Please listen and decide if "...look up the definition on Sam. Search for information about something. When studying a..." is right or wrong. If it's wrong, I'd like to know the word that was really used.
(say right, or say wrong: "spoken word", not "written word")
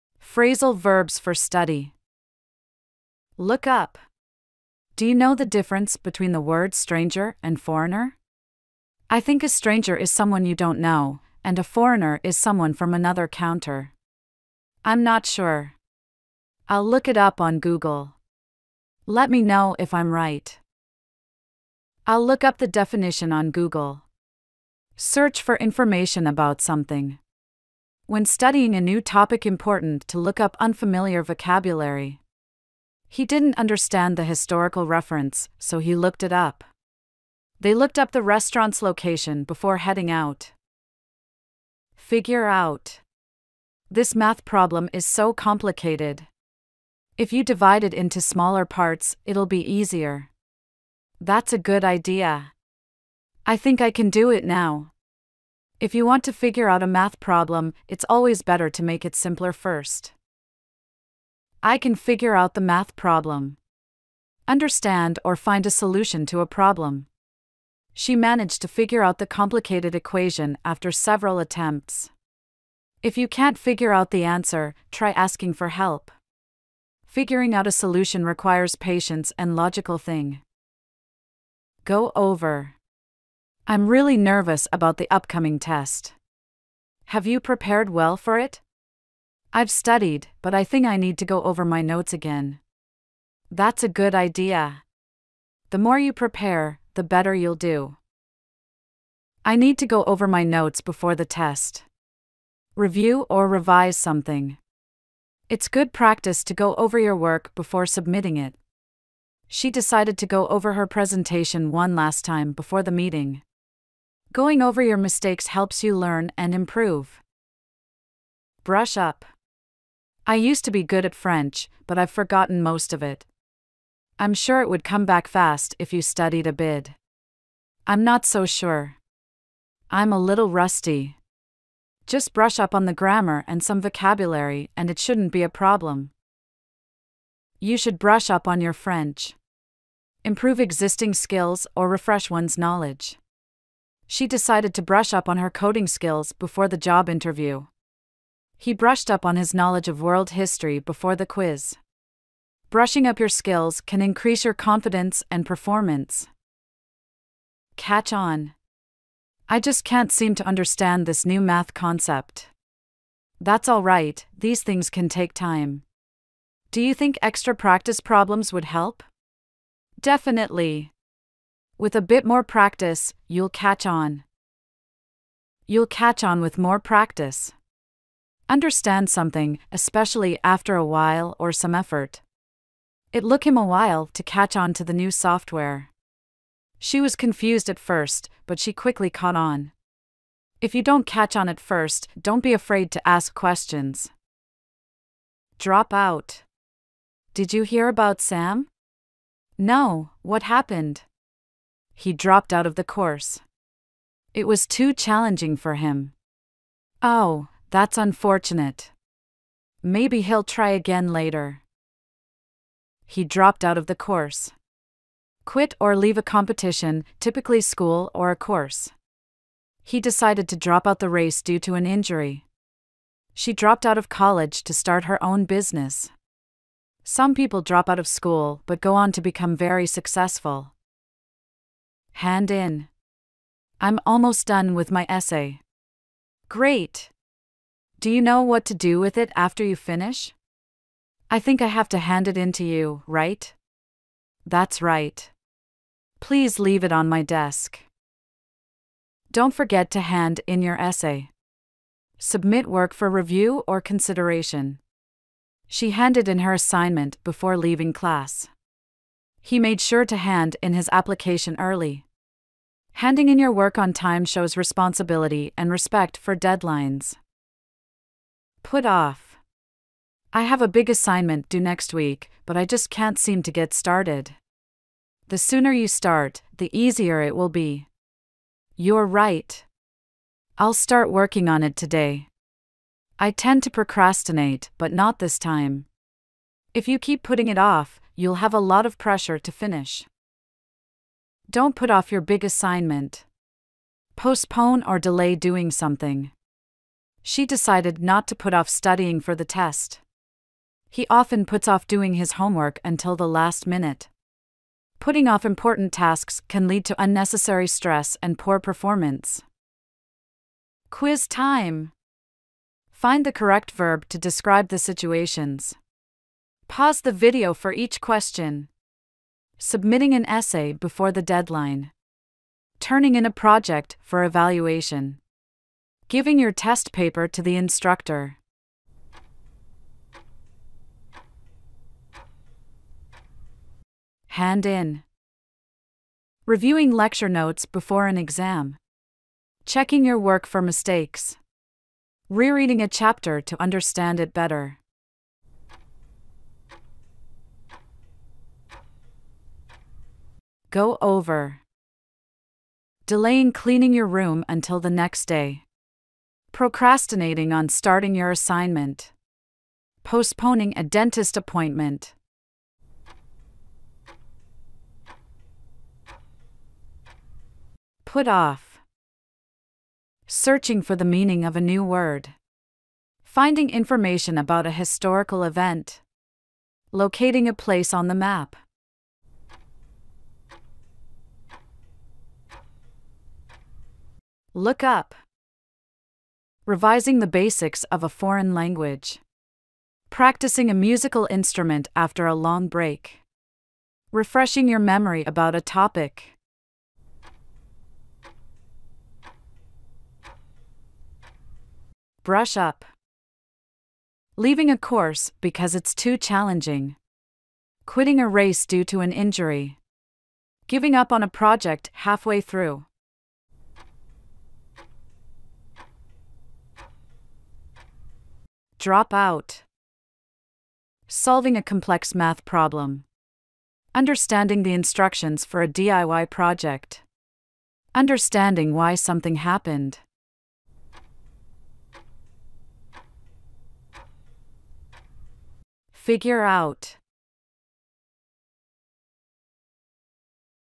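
wrong: "Google", not "Sam".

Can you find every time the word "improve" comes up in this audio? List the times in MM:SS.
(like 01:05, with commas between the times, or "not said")
01:56, 02:20.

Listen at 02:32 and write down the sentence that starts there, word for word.
Brushing up your skills can increase your confidence and performance.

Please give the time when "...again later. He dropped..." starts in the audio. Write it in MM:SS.
03:30.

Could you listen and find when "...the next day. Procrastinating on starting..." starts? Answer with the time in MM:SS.
05:54.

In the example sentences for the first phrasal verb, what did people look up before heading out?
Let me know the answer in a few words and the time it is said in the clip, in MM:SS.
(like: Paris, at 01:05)
the restaurant's location, at 00:38.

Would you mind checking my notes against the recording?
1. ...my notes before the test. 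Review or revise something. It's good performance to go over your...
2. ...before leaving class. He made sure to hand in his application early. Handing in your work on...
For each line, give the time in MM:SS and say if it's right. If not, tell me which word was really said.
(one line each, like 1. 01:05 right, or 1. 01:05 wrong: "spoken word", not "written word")
1. 01:40 wrong: "practice", not "performance"
2. 04:17 right.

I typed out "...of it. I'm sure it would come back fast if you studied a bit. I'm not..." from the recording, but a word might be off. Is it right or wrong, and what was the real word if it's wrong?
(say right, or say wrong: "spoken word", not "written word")
right.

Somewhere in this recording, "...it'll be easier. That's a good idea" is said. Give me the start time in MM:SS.
00:49.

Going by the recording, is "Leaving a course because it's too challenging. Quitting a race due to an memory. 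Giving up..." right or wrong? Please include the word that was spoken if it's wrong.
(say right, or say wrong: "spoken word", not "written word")
wrong: "injury", not "memory".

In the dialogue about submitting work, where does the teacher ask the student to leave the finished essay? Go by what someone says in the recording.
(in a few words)
on my desk.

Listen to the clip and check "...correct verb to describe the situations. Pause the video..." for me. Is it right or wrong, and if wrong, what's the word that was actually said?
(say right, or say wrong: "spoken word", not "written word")
right.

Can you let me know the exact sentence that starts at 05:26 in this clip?
Giving your test paper to the instructor.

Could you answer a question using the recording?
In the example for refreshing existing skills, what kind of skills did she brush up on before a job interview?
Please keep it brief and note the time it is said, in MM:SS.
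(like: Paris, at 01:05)
coding skills, at 02:25.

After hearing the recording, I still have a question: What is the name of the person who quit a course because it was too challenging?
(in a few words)
Sam.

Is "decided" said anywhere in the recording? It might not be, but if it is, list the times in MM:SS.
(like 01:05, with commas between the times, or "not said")
01:49, 02:24, 03:40, 04:57.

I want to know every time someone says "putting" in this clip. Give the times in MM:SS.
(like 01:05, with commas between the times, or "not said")
04:47, 05:04.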